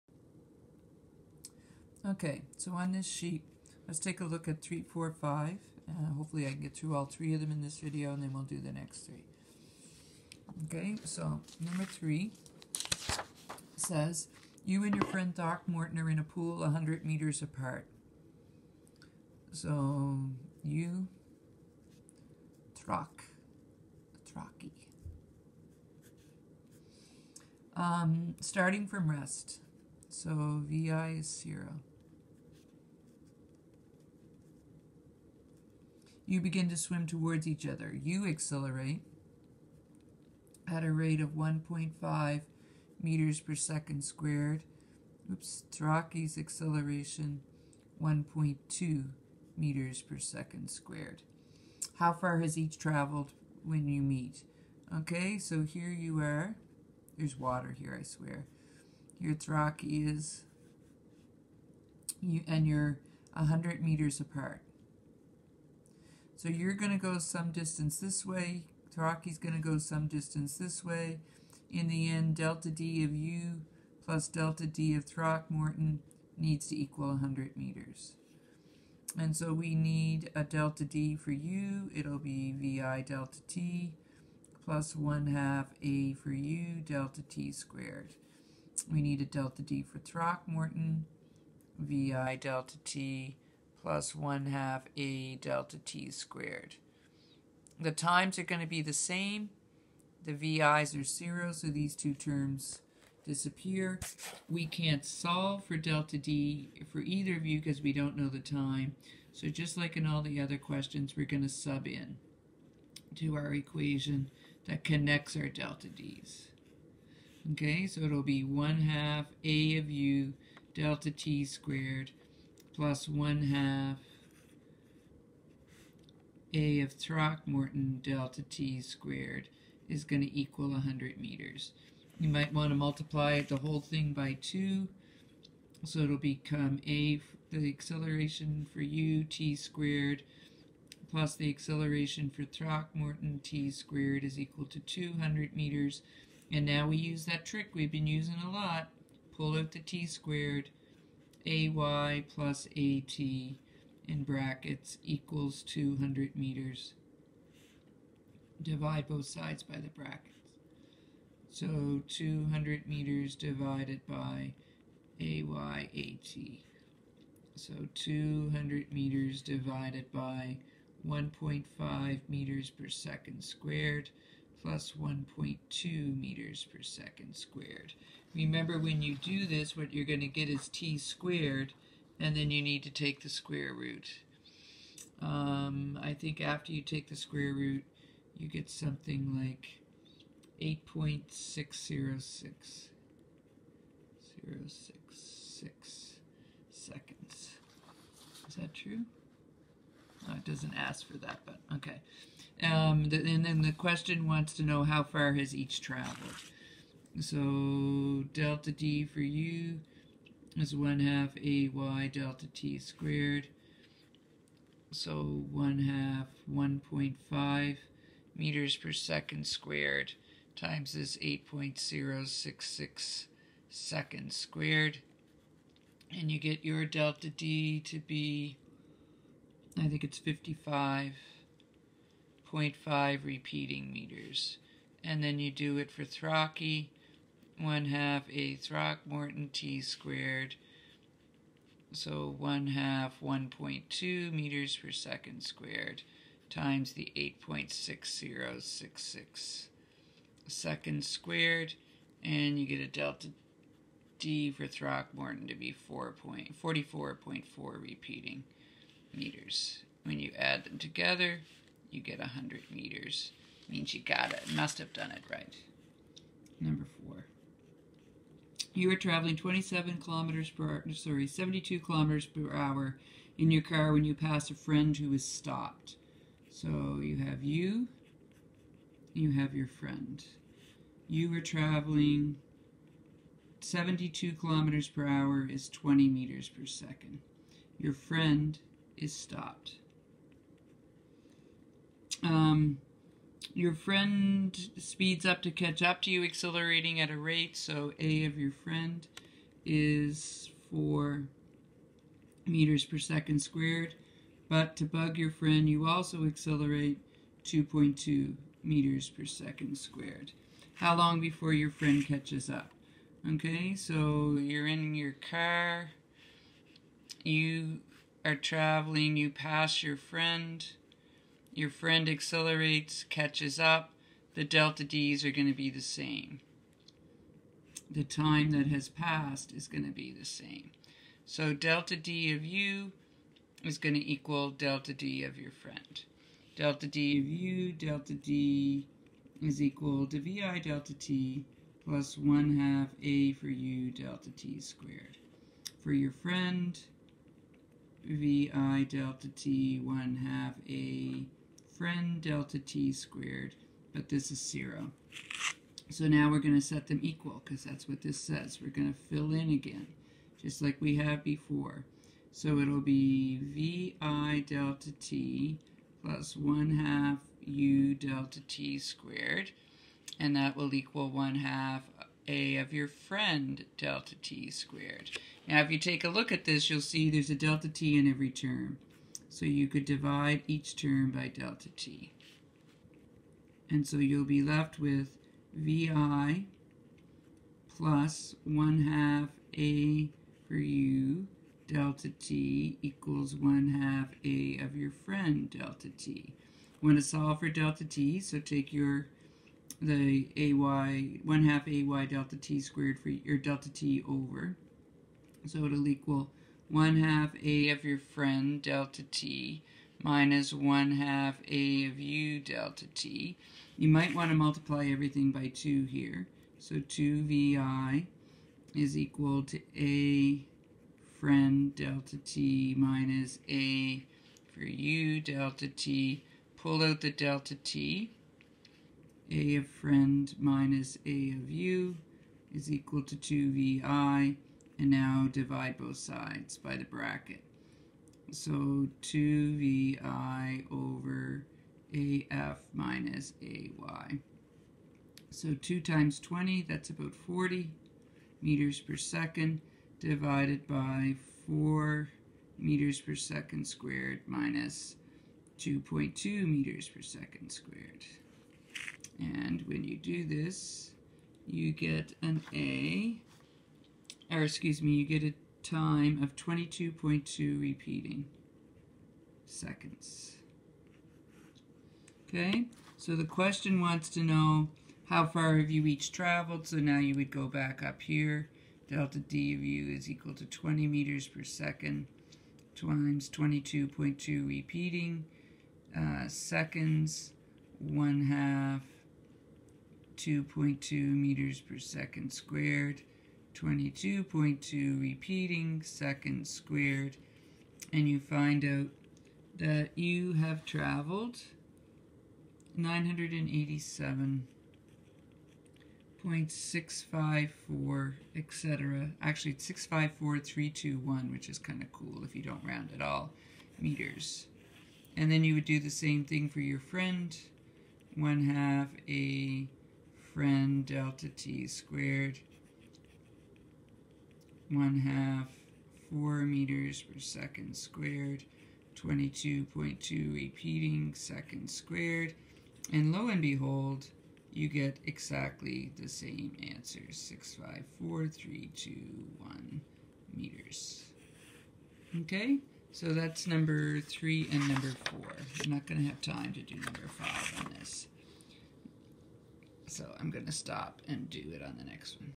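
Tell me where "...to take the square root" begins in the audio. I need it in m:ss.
3:02.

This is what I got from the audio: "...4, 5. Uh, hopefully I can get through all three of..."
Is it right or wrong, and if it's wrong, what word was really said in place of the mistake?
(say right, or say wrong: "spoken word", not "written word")
right.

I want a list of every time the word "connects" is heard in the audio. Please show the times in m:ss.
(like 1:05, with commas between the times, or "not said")
1:54.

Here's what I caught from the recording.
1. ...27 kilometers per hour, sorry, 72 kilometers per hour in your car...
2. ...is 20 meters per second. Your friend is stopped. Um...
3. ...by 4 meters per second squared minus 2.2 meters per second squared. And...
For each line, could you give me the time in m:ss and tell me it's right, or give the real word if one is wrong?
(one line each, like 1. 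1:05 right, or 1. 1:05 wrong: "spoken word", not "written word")
1. 4:29 right
2. 4:45 right
3. 7:30 right.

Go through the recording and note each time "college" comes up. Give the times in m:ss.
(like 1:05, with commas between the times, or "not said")
not said.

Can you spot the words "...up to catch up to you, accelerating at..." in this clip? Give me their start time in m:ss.
4:55.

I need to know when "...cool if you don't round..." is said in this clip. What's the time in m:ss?
8:31.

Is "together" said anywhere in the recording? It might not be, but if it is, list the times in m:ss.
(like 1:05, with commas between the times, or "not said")
4:20.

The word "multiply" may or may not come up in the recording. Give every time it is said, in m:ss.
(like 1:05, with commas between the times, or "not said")
2:12, 6:54.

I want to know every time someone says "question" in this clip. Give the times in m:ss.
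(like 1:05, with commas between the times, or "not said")
1:50, 3:23, 7:53.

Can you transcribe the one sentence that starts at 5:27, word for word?
The time that has passed is going to be the same.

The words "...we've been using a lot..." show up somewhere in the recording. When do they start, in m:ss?
2:27.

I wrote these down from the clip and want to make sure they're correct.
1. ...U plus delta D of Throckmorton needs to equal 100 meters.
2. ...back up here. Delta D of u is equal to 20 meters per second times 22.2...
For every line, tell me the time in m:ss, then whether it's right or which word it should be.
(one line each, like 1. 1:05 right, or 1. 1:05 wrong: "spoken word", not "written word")
1. 1:13 right
2. 7:57 right.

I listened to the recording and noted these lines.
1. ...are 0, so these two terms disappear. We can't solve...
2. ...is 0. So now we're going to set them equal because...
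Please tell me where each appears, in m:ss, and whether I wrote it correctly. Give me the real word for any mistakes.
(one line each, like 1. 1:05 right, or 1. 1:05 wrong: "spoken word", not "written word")
1. 1:40 right
2. 5:54 right.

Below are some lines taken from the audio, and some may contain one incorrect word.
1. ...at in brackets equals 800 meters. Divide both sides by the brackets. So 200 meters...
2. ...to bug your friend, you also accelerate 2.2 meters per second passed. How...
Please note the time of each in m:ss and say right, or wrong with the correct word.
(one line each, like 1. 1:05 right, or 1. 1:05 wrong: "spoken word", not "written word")
1. 2:32 wrong: "200", not "800"
2. 5:04 wrong: "squared", not "passed".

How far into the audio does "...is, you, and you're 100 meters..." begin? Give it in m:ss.
1:00.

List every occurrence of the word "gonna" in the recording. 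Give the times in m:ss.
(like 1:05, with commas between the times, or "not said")
9:05, 9:10.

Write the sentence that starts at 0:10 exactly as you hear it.
Okay, so number 3 says, You and your friend Throckmorton are in a pool 100 meters apart.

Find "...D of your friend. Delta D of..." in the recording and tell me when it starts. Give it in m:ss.
5:34.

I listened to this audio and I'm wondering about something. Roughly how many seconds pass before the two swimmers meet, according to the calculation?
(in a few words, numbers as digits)
8.606 seconds.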